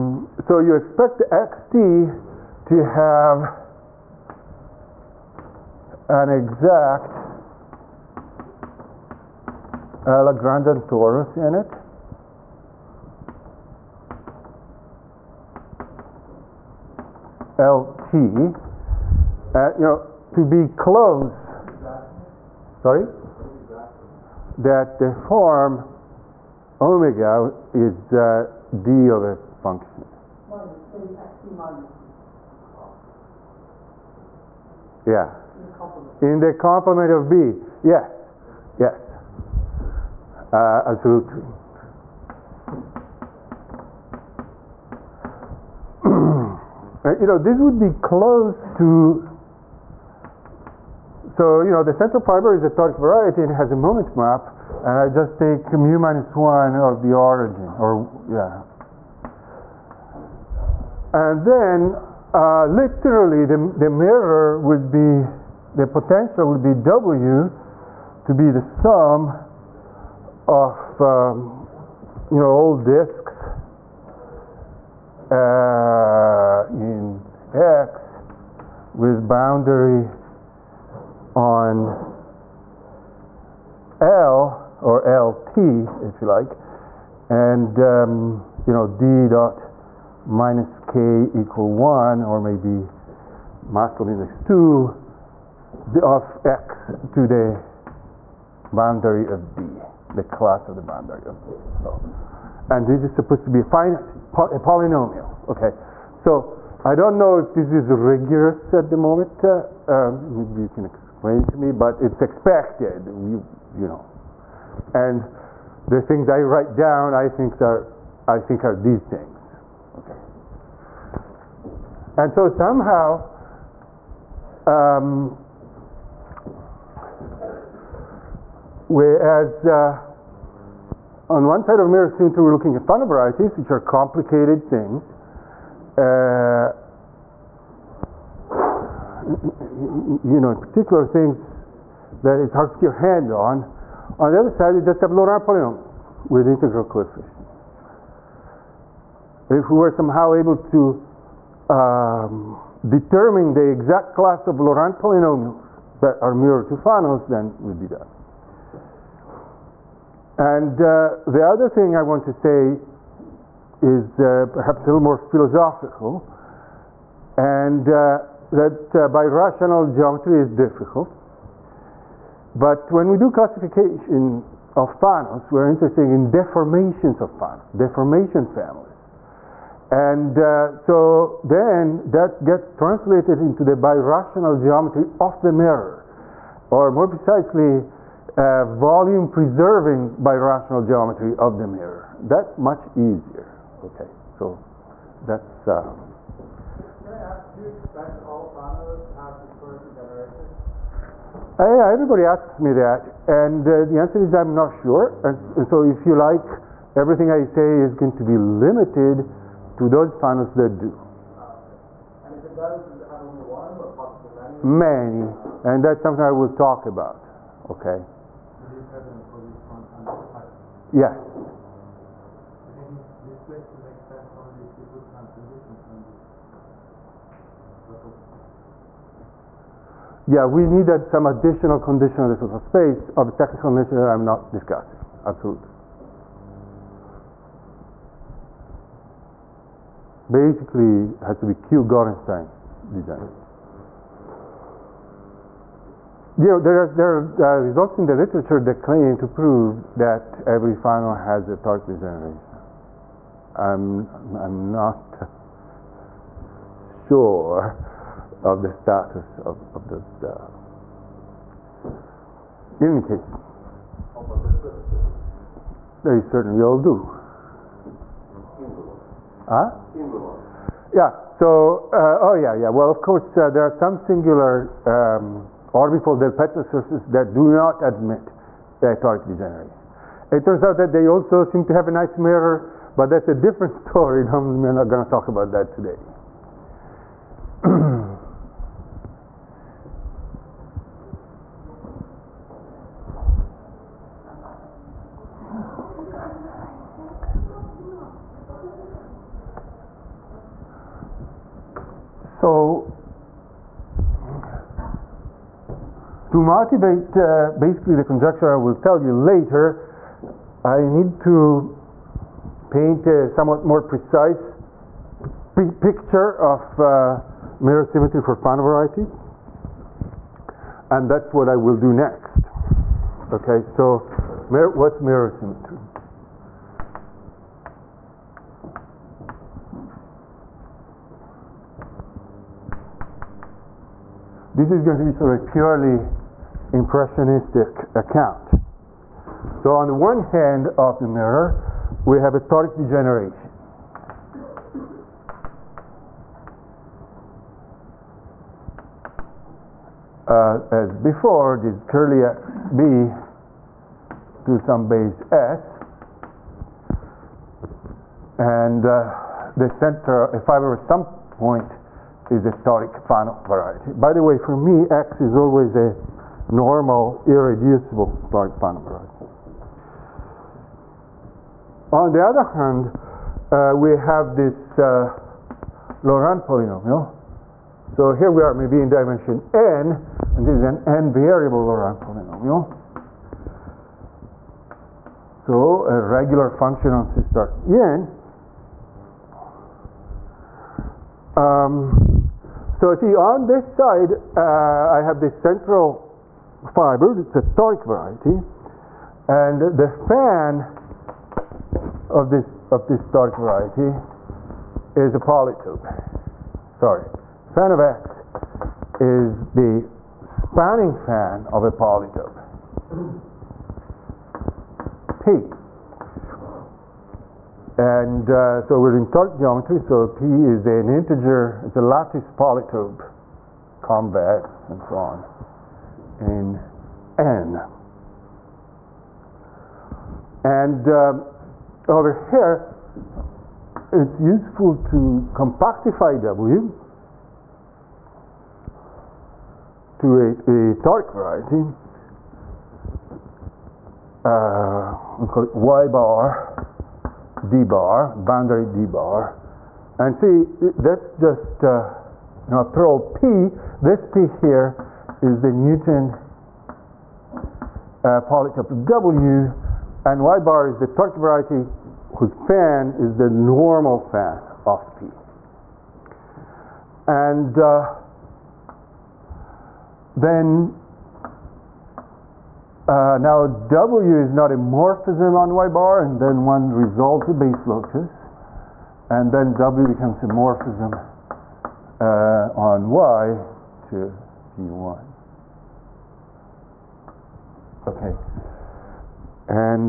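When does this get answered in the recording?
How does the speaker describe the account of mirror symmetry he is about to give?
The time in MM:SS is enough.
05:35.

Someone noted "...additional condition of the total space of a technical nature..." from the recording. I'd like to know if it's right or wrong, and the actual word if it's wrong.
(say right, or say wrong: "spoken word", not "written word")
right.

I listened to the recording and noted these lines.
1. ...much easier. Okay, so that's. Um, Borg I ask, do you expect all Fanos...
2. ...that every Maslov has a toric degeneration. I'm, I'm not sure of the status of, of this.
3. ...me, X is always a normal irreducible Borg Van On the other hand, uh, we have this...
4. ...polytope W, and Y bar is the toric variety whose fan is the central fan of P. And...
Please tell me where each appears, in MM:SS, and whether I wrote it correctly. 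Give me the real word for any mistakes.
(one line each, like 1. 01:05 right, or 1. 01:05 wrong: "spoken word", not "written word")
1. 03:12 wrong: "Can", not "Borg"
2. 04:09 wrong: "Fano", not "Maslov"
3. 06:04 right
4. 07:38 wrong: "normal", not "central".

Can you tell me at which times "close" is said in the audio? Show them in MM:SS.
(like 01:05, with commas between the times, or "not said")
00:20, 00:47.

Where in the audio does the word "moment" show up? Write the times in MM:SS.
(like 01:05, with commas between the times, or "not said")
00:53, 01:48.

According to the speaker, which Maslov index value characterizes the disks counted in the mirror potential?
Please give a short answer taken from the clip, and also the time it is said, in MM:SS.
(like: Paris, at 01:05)
2, at 01:33.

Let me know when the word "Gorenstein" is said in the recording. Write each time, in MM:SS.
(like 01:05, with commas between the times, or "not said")
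04:01.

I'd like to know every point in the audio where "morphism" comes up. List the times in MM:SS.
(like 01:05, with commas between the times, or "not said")
07:54, 08:00.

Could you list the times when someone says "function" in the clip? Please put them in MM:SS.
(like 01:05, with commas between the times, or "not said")
00:29, 06:26.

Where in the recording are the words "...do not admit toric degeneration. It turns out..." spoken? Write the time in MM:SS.
04:37.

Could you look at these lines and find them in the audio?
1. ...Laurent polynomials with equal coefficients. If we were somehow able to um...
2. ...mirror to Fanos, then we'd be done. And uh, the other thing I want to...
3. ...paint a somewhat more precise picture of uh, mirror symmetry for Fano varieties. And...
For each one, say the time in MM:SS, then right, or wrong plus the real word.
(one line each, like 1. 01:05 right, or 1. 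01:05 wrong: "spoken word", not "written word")
1. 02:25 wrong: "integral", not "equal"
2. 02:36 right
3. 05:12 right.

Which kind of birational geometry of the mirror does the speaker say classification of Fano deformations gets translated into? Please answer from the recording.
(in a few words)
volume preserving.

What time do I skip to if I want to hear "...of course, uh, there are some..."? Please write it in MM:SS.
04:32.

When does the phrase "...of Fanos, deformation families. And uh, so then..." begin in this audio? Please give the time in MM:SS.
02:57.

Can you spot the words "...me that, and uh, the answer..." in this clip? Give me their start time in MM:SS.
03:22.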